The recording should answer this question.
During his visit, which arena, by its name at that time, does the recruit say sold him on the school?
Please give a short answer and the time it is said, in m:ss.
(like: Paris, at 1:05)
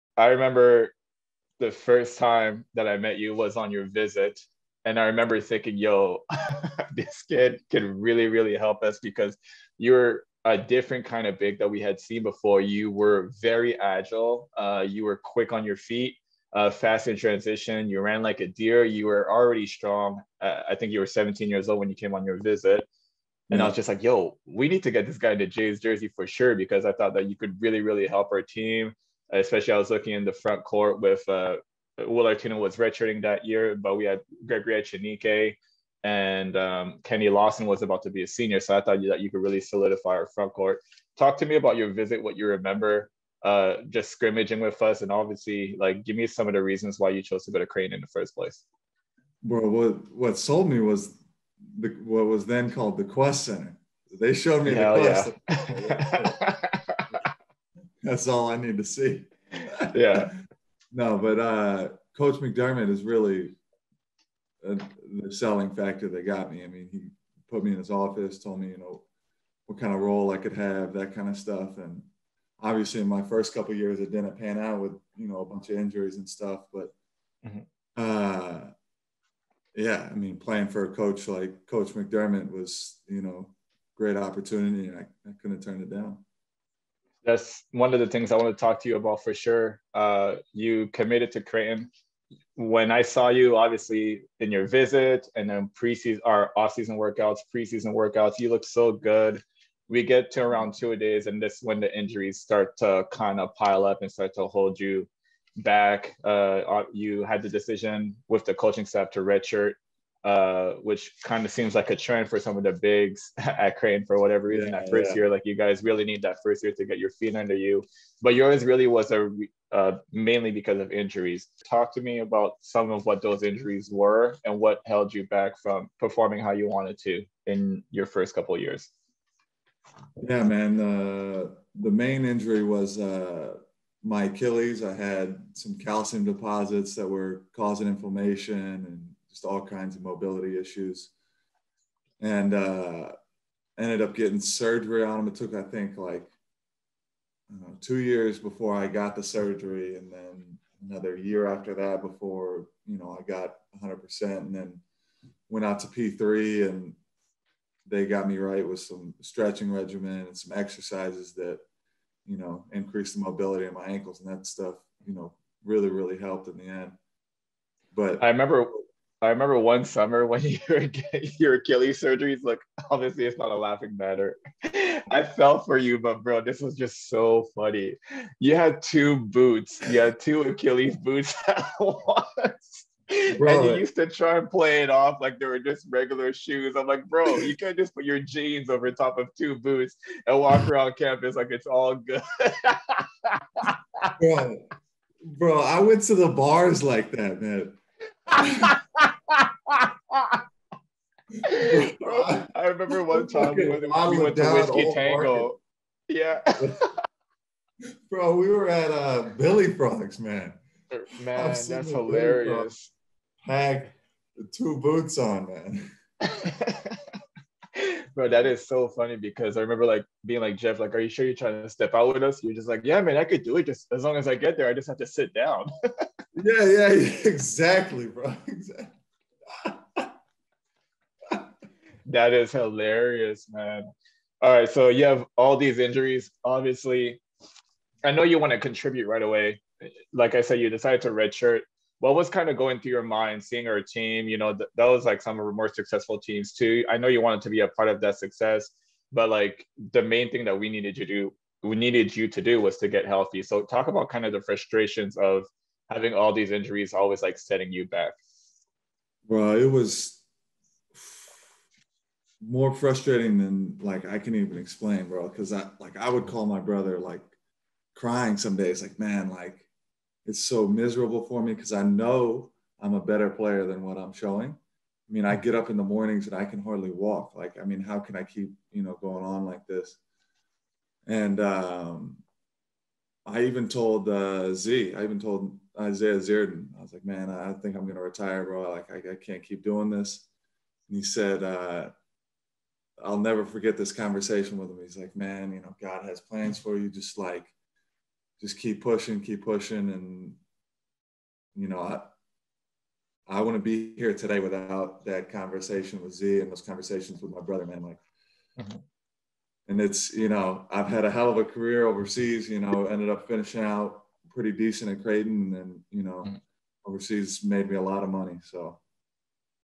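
Qwest Center, at 0:53.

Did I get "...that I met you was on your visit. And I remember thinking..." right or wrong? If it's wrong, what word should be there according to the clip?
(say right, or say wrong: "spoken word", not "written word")
right.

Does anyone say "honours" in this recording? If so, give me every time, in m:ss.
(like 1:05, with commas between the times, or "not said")
not said.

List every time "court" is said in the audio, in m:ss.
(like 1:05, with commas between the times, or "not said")
0:30, 0:40.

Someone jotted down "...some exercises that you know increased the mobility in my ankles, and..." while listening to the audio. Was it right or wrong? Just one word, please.
right.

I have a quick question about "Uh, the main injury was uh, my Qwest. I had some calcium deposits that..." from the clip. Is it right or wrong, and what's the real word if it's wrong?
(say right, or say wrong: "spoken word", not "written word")
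wrong: "Achilles", not "Qwest".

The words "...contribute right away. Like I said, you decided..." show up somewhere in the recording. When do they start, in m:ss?
3:58.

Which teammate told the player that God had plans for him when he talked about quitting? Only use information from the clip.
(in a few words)
Isaiah Zierden.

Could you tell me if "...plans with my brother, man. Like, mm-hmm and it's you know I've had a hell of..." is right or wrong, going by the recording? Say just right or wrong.
wrong.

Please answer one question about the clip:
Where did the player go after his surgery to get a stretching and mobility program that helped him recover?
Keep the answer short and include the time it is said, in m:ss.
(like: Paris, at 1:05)
P3, at 2:35.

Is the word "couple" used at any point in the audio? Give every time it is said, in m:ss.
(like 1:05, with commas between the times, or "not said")
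1:13, 2:08.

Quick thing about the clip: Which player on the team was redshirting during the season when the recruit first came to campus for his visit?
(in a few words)
Will Artino.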